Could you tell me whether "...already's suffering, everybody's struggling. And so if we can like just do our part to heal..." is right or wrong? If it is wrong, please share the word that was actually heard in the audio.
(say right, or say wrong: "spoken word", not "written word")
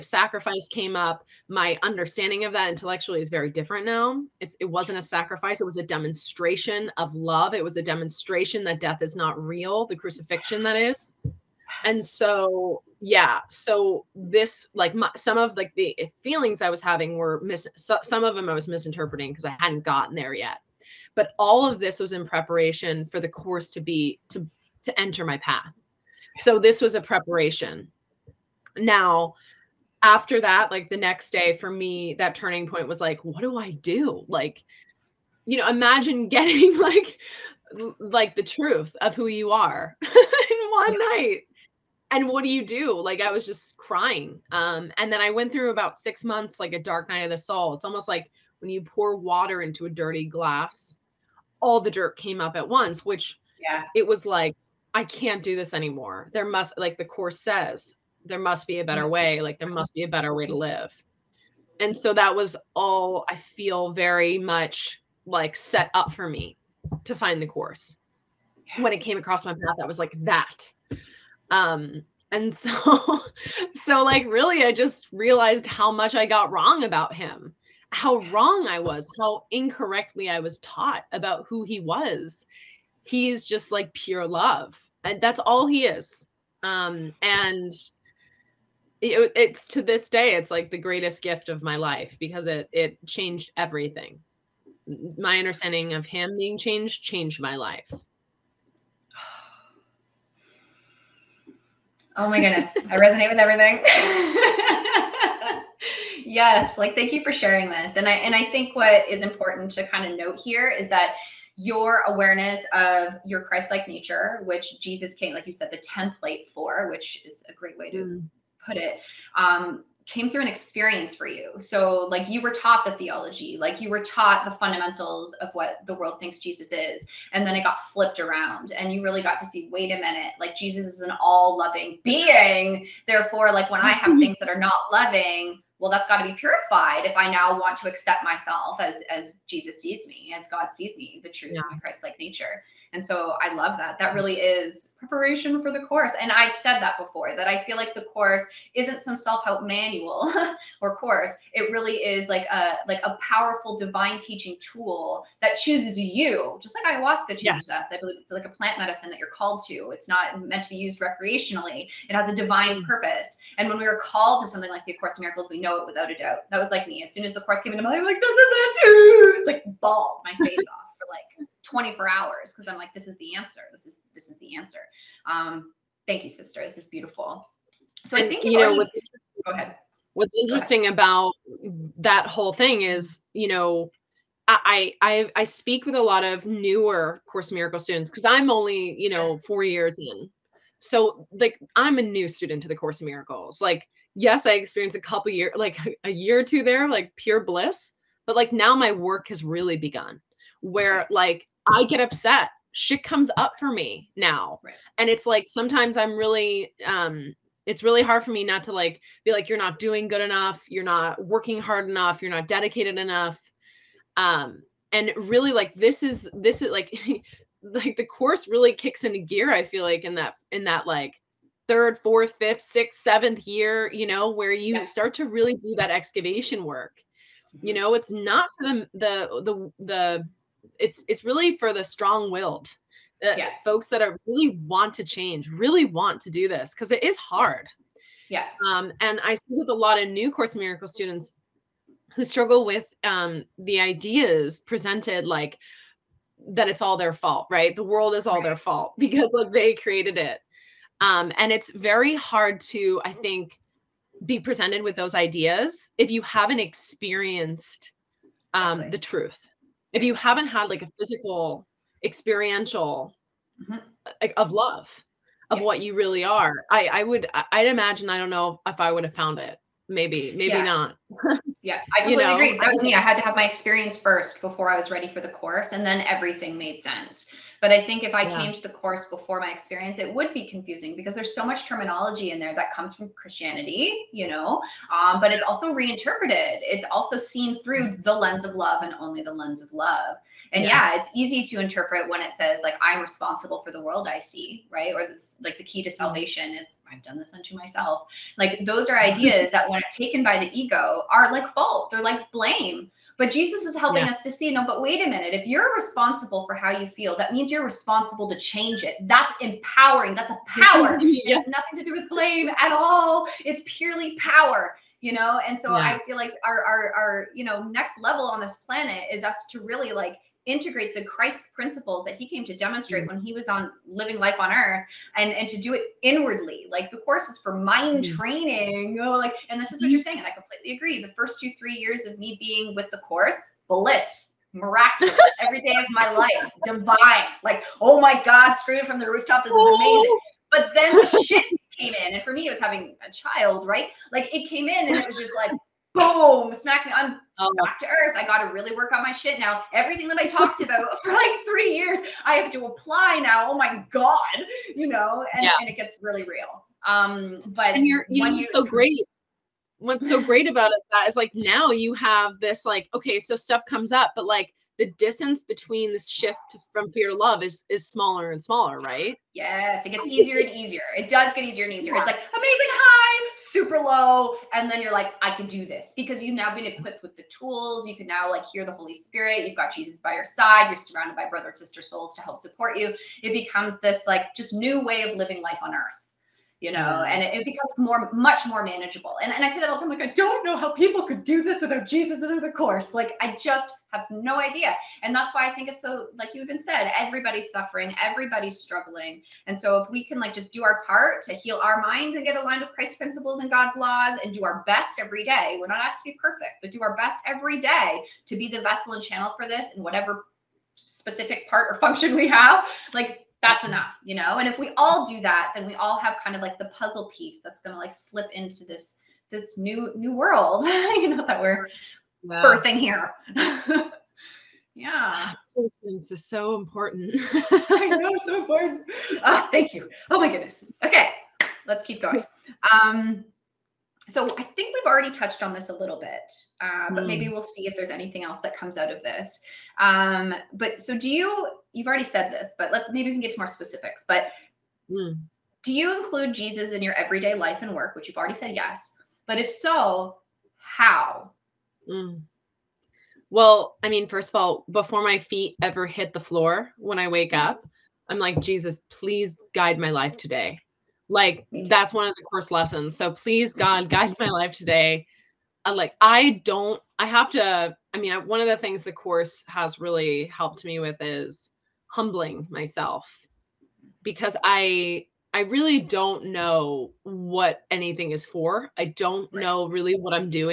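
wrong: "everybody", not "already".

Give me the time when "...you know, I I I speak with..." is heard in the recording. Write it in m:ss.
3:03.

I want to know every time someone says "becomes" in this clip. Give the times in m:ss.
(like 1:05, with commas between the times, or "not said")
6:23, 6:27.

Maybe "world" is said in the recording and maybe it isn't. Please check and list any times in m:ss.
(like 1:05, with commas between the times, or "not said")
2:05, 4:07, 4:53, 7:00.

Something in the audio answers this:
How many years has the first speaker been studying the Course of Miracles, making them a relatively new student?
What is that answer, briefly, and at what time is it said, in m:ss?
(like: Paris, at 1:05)
4 years, at 3:09.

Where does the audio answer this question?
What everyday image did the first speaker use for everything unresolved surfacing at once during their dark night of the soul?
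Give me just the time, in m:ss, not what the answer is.
0:49.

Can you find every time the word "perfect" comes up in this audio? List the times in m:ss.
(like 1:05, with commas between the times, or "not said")
6:46.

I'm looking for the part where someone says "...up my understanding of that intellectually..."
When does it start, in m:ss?
0:00.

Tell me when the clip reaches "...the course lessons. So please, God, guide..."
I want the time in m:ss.
7:42.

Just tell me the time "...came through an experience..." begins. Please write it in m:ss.
2:00.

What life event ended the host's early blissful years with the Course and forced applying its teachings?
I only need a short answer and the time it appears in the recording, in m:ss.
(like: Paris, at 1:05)
having a child, at 5:42.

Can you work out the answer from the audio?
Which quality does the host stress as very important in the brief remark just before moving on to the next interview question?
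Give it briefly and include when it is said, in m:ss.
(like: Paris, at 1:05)
Patience, at 7:05.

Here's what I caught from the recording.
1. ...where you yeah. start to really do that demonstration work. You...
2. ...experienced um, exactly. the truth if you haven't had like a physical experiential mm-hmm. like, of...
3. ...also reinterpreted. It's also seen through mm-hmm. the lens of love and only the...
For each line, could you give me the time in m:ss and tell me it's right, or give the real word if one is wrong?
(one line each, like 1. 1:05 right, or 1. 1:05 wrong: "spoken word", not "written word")
1. 3:44 wrong: "excavation", not "demonstration"
2. 4:16 right
3. 4:45 right.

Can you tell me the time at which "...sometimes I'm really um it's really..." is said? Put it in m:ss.
3:25.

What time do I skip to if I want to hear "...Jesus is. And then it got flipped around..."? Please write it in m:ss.
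2:06.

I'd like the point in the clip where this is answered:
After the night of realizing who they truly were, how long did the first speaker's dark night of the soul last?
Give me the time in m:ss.
0:45.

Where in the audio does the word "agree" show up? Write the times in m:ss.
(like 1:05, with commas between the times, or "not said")
4:32, 5:30.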